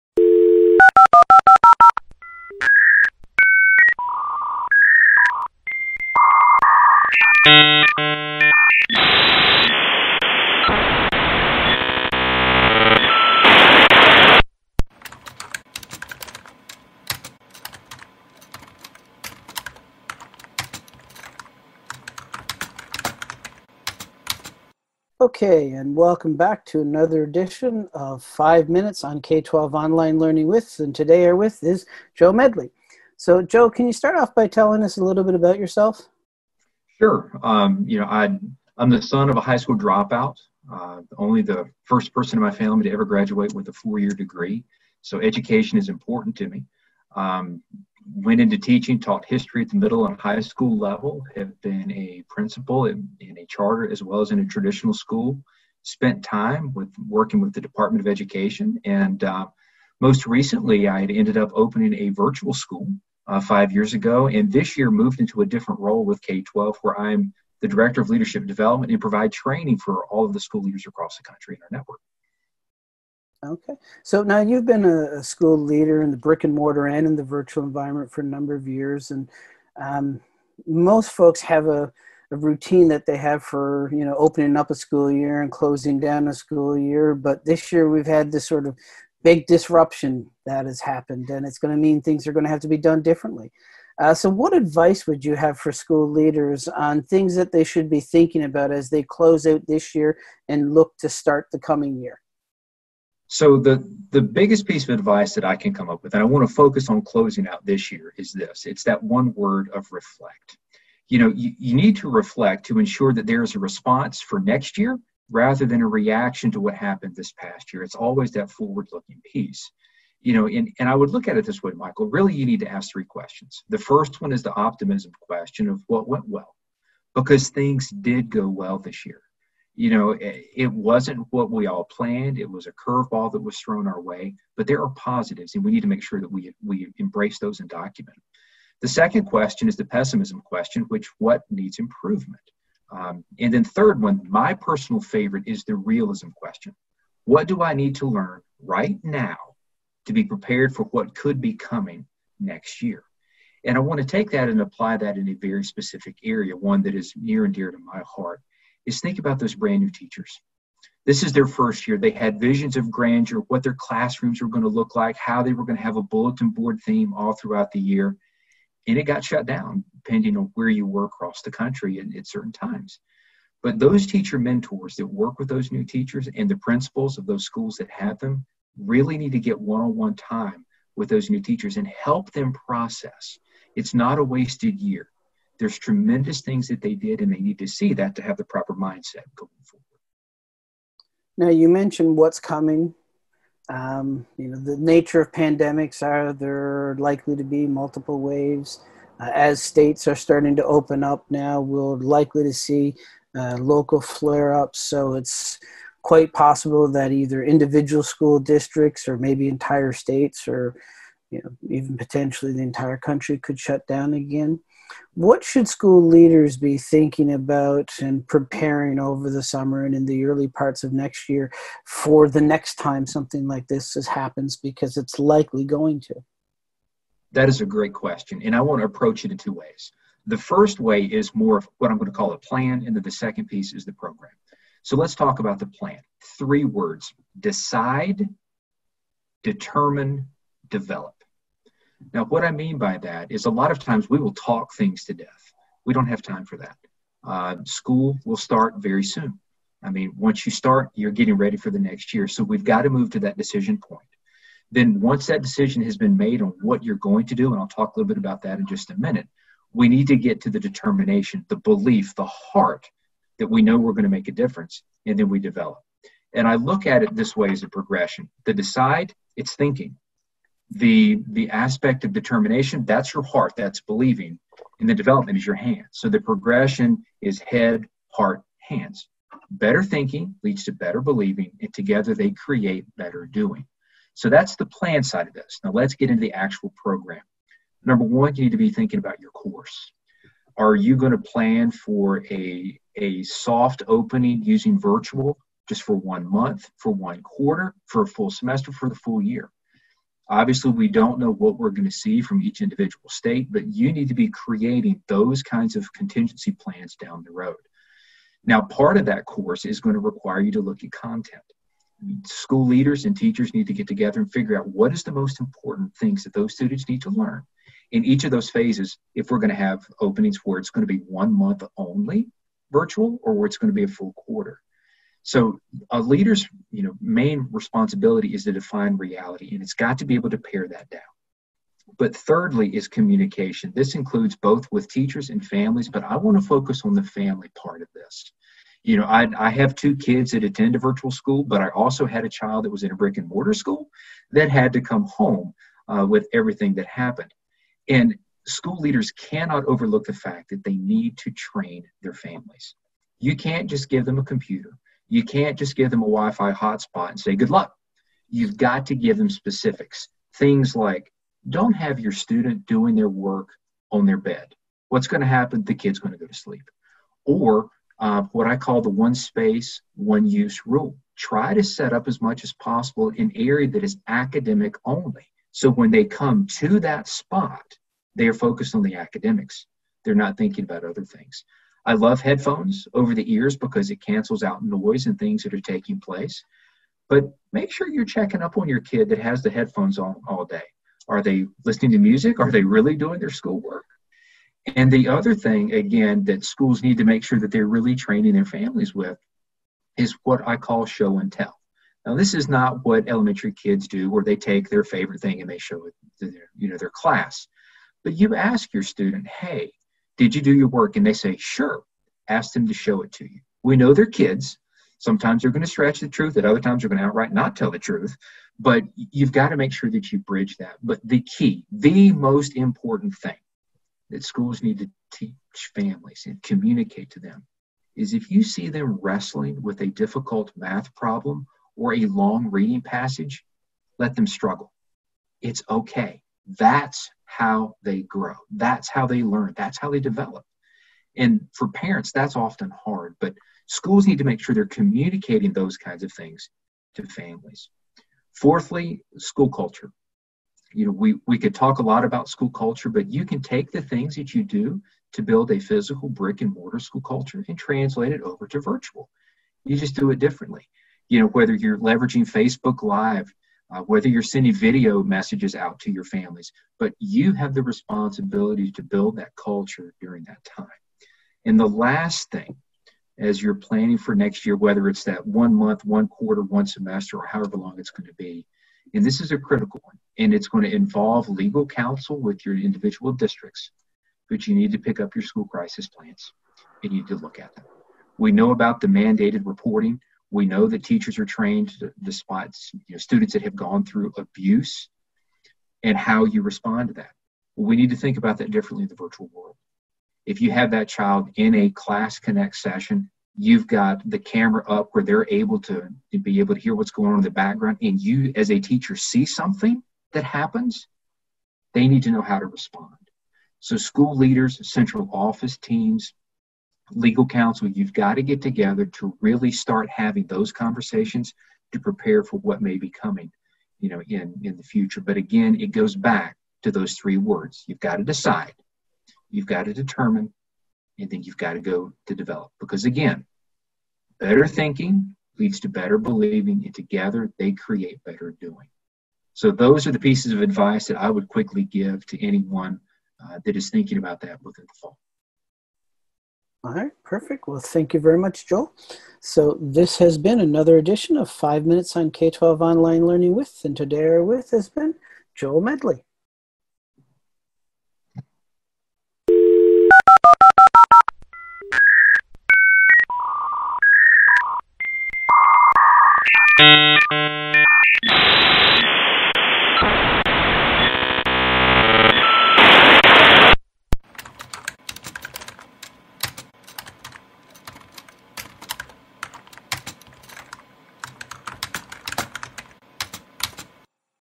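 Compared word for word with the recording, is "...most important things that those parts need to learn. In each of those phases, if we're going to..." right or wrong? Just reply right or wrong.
wrong.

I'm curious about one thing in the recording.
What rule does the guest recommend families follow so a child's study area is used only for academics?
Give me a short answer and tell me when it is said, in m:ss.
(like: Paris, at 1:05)
one space, one use rule, at 6:08.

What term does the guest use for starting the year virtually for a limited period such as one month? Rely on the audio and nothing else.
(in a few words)
soft opening.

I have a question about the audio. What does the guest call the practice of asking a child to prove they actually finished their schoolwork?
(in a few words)
show and tell.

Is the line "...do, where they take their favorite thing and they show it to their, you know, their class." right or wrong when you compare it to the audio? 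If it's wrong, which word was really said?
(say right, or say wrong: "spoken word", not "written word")
right.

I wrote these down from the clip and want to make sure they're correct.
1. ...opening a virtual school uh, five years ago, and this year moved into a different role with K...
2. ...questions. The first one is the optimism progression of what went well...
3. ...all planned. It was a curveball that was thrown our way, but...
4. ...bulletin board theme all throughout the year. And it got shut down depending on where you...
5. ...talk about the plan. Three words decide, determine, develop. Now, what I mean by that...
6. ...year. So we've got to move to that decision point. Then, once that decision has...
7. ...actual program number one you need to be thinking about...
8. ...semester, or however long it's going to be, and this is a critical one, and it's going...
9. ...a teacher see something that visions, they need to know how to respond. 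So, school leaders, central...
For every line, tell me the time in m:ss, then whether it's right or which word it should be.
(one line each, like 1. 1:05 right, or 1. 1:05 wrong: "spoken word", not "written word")
1. 1:01 right
2. 2:03 wrong: "question", not "progression"
3. 2:11 right
4. 2:46 right
5. 3:55 right
6. 4:12 right
7. 4:46 right
8. 7:56 right
9. 8:28 wrong: "happens", not "visions".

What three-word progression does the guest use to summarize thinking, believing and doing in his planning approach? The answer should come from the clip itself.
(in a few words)
head heart hands.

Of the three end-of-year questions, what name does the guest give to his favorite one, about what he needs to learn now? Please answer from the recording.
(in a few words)
realism question.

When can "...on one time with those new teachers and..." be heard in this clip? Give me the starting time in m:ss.
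2:59.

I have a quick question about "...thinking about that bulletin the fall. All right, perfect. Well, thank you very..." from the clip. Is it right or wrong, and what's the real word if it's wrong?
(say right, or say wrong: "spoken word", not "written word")
wrong: "within", not "bulletin".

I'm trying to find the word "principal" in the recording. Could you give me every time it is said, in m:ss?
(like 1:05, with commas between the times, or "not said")
0:52, 2:56.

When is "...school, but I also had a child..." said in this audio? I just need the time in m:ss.
5:41.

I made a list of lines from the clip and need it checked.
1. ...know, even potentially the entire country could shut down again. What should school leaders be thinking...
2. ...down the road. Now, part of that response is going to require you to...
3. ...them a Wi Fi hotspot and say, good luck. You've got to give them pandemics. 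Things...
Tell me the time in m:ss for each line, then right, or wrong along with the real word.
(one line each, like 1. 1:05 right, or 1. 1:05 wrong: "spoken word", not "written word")
1. 3:31 right
2. 5:06 wrong: "course", not "response"
3. 5:55 wrong: "specifics", not "pandemics".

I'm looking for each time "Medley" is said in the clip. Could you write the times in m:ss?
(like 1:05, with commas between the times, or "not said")
0:32, 9:15.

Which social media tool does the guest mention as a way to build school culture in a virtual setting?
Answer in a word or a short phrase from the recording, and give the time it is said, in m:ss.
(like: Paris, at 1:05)
Facebook Live, at 7:42.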